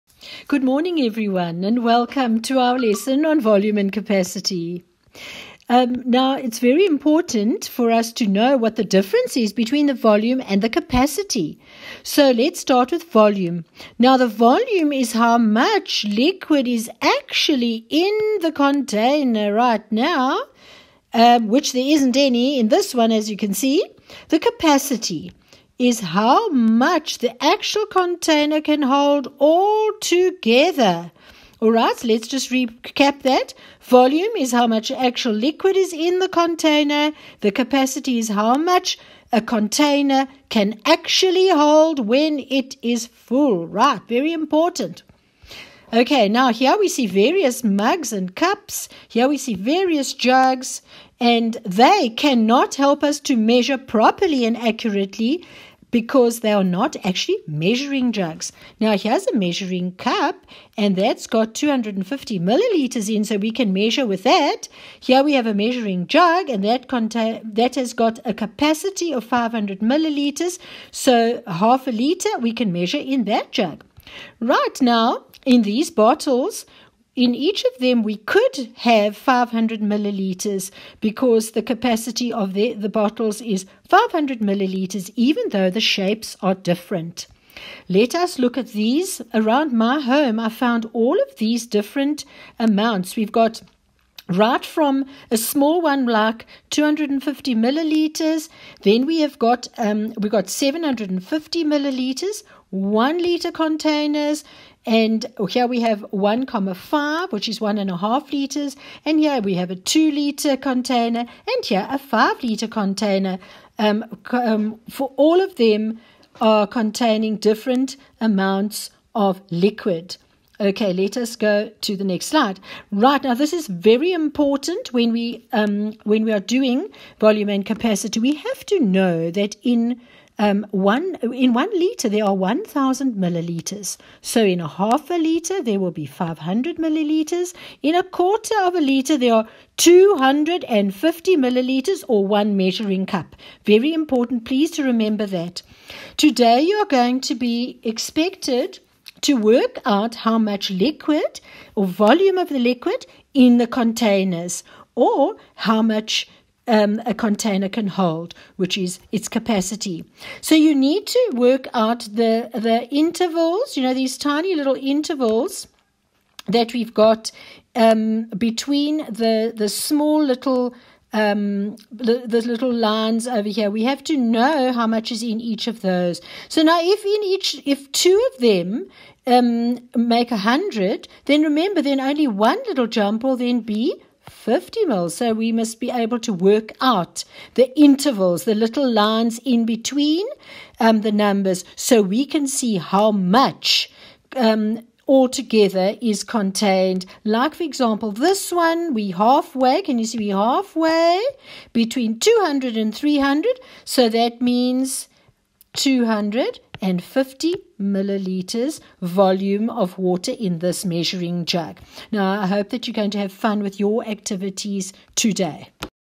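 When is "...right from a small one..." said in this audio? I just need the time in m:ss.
1:34.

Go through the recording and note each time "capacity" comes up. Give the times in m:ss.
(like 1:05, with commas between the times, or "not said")
0:03, 0:10, 0:24, 0:37, 1:08, 1:21, 2:07, 2:39.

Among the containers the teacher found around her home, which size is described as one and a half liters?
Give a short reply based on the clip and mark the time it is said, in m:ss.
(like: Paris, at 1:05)
1,5, at 1:46.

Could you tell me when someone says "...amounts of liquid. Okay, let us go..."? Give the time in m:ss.
1:58.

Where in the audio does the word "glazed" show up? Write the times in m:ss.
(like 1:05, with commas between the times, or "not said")
not said.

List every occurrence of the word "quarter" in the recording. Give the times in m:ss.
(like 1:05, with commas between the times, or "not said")
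2:18.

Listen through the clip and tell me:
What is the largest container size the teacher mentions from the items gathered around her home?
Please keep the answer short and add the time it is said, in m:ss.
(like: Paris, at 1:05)
5 liters, at 1:51.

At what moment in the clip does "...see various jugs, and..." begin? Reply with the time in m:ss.
0:49.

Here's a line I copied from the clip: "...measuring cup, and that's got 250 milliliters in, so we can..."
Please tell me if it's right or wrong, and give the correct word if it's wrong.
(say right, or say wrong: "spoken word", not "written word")
right.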